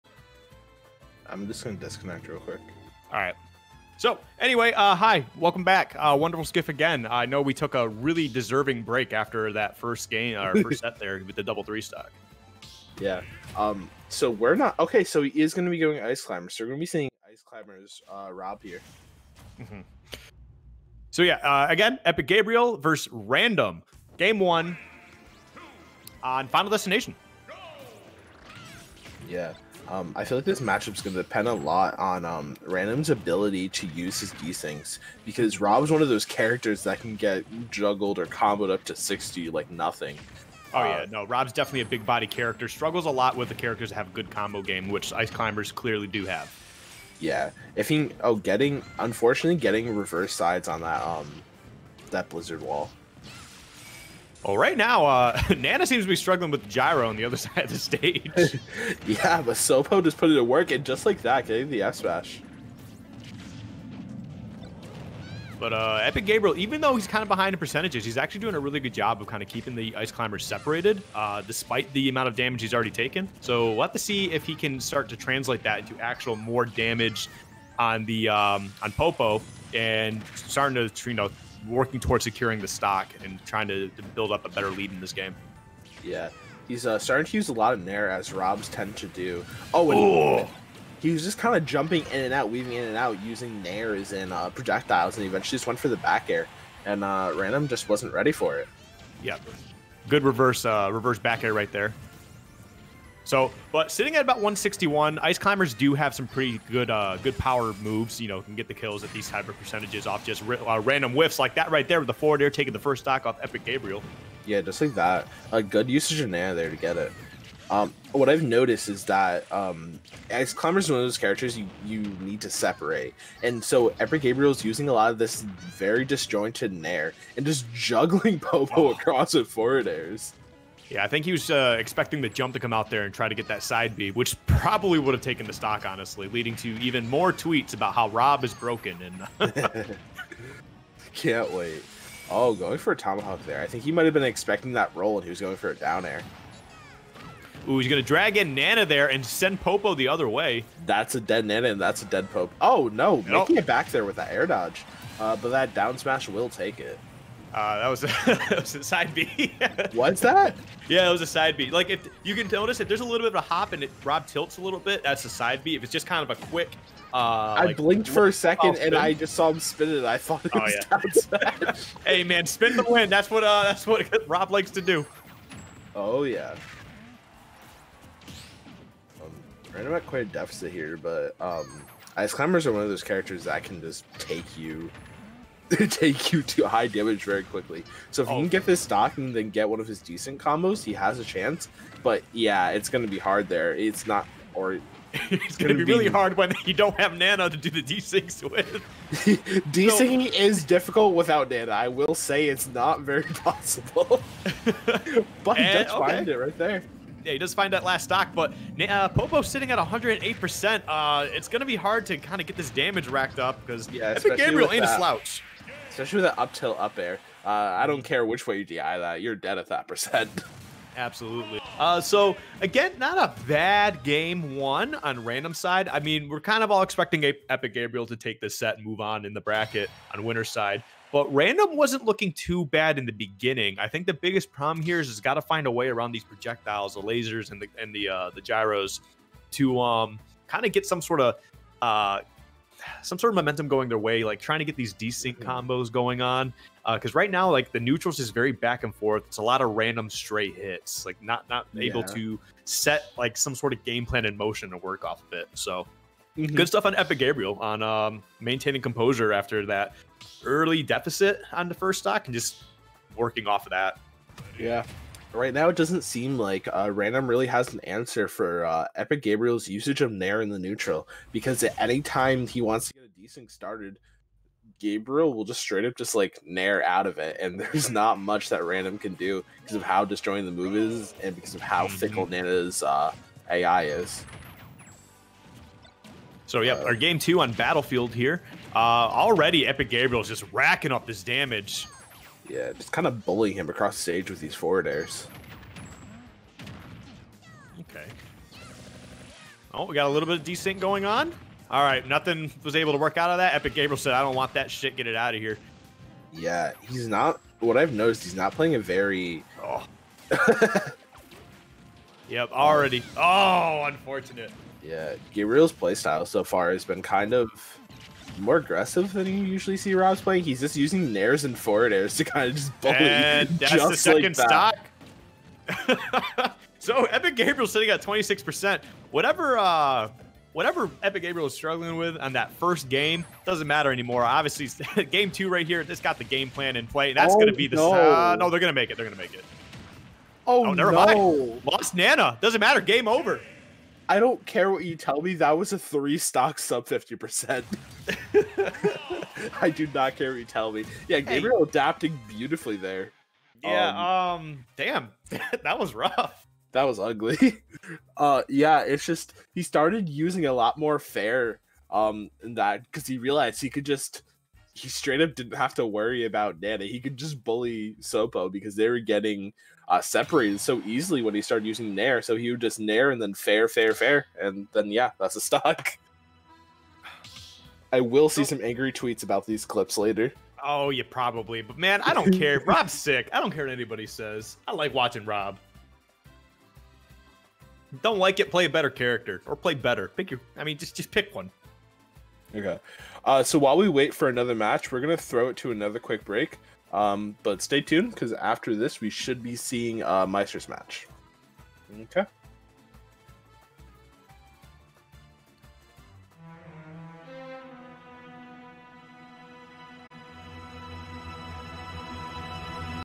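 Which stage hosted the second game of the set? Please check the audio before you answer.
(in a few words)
Battlefield.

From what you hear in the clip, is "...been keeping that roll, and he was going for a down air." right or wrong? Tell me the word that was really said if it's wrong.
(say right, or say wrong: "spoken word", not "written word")
wrong: "expecting", not "keeping".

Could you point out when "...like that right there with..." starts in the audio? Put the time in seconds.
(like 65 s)
111 s.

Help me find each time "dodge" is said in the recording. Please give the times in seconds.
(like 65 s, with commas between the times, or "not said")
154 s.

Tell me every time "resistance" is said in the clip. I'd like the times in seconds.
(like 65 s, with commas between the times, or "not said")
not said.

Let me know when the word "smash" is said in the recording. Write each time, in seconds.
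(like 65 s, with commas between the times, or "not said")
61 s, 155 s.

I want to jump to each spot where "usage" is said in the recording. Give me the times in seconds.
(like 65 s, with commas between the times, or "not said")
115 s, 269 s.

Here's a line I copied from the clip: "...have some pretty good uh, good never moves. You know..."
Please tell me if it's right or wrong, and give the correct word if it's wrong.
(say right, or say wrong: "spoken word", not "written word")
wrong: "power", not "never".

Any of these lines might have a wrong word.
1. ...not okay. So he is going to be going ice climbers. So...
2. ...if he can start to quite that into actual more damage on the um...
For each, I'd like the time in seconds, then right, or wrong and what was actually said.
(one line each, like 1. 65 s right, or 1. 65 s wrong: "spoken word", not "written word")
1. 14 s right
2. 74 s wrong: "translate", not "quite".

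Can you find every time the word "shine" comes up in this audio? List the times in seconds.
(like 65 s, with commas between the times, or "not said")
not said.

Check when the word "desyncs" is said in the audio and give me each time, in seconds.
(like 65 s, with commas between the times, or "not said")
34 s, 197 s, 273 s, 300 s.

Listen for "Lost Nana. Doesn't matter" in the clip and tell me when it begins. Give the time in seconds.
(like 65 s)
341 s.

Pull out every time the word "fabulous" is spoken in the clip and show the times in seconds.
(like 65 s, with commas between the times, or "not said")
not said.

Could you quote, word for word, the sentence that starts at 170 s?
I thought it oh, was oh, yeah.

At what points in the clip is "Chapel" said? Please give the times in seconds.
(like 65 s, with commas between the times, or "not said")
not said.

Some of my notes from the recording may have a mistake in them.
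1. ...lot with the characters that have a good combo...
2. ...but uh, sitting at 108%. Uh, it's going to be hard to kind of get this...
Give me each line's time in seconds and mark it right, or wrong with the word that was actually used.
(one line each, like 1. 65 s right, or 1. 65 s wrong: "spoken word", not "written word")
1. 43 s right
2. 208 s right.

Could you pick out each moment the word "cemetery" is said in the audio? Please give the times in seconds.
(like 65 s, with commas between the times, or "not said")
not said.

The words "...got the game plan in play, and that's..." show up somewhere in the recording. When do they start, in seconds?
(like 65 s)
335 s.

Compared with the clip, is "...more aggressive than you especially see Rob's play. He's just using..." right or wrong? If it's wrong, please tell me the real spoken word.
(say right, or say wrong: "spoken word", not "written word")
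wrong: "usually", not "especially".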